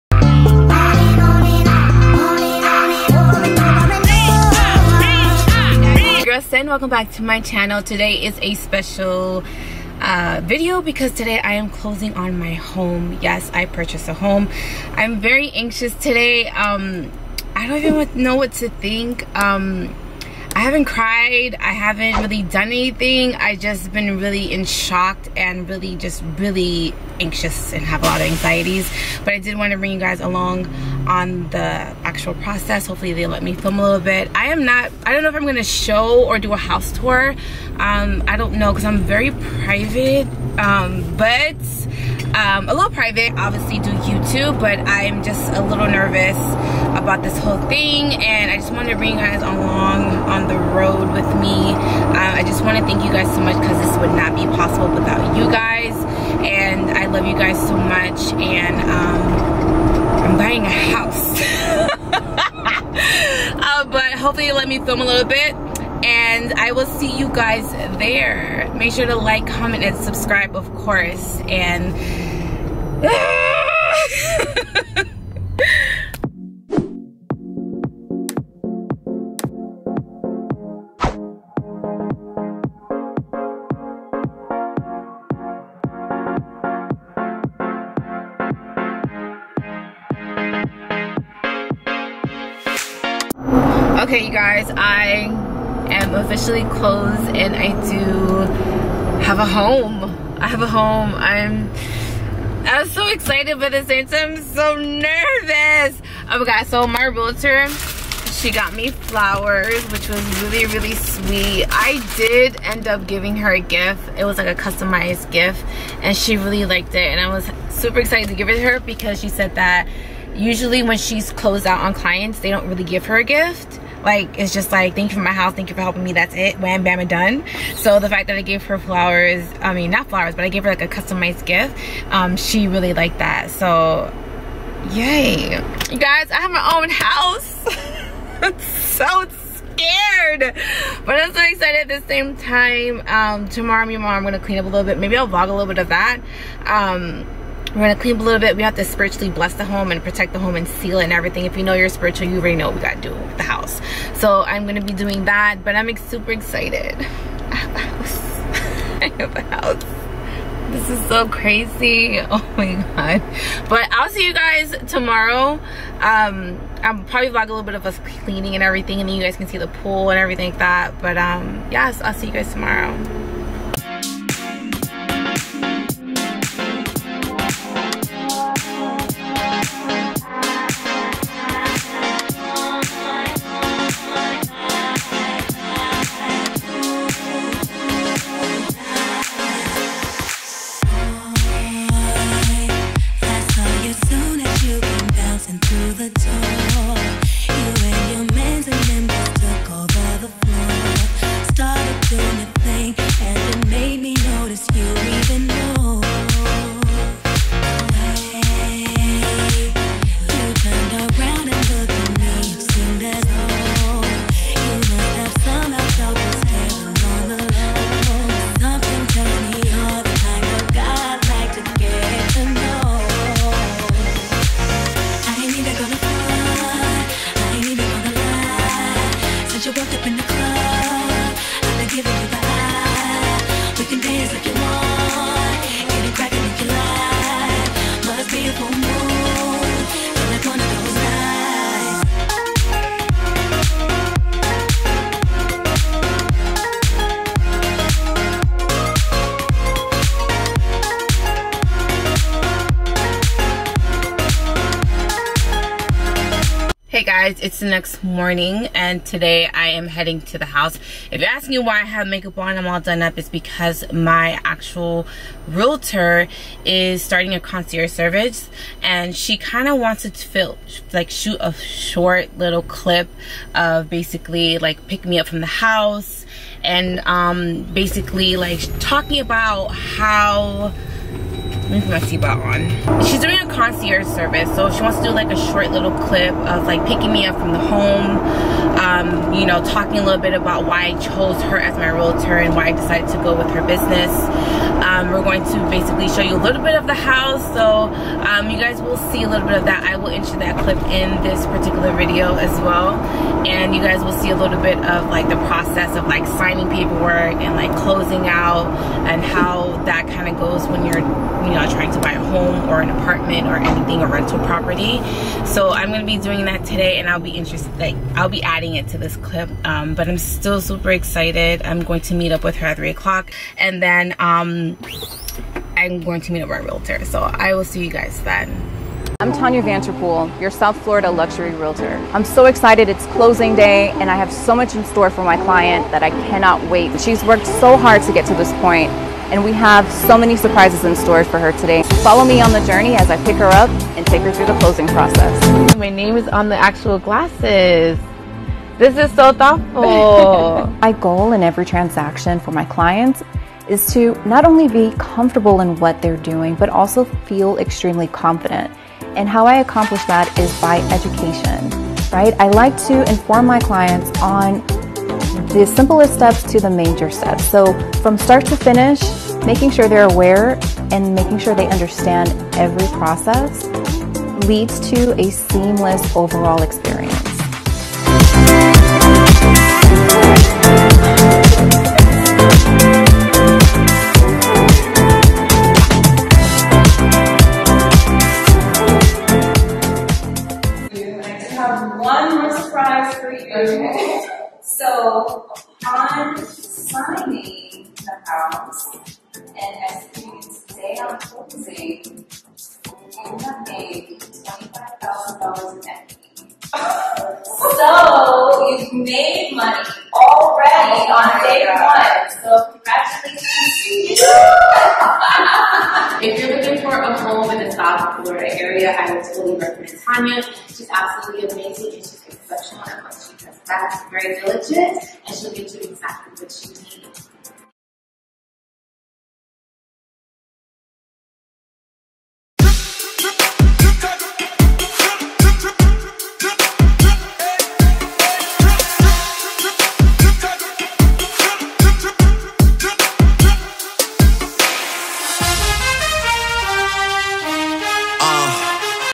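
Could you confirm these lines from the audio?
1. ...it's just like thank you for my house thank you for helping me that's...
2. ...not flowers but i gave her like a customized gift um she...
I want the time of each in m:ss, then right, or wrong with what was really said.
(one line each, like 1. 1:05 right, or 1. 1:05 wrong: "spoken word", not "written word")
1. 2:04 right
2. 2:09 right.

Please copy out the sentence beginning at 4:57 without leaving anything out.
So um, you guys will see a little bit of that.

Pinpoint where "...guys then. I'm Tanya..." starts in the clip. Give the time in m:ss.
5:27.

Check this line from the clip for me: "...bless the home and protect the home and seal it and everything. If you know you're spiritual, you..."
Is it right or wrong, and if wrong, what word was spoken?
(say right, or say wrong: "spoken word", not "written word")
right.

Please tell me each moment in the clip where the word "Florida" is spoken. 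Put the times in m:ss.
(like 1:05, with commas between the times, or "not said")
5:30, 6:58.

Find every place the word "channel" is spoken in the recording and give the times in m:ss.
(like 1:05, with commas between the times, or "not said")
0:07.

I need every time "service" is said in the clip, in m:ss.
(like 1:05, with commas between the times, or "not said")
4:27, 4:44.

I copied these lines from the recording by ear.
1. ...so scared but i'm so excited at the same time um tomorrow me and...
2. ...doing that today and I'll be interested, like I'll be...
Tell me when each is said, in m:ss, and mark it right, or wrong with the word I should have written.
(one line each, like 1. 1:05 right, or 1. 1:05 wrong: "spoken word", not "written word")
1. 2:18 right
2. 5:16 right.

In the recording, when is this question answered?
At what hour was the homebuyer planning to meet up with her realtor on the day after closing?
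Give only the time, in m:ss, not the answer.
5:22.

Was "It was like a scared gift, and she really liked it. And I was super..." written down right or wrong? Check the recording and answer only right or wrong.
wrong.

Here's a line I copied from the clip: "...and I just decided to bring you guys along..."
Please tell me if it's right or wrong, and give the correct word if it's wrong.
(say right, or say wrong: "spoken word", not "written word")
wrong: "wanted", not "decided".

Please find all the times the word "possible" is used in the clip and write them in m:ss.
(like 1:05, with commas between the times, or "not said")
0:54.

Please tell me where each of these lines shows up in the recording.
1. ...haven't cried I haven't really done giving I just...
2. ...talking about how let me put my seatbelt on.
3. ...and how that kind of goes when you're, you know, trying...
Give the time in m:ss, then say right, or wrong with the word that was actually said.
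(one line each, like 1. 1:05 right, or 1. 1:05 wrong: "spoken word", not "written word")
1. 0:20 wrong: "anything", not "giving"
2. 4:38 right
3. 5:09 right.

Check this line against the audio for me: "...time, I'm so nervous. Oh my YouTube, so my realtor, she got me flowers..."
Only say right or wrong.
wrong.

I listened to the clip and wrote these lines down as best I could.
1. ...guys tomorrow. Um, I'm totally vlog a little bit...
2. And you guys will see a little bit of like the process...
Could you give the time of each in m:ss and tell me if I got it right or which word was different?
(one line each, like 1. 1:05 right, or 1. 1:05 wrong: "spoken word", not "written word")
1. 2:44 wrong: "probably", not "totally"
2. 5:03 right.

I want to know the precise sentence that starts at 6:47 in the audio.
so you've made money already oh on day God.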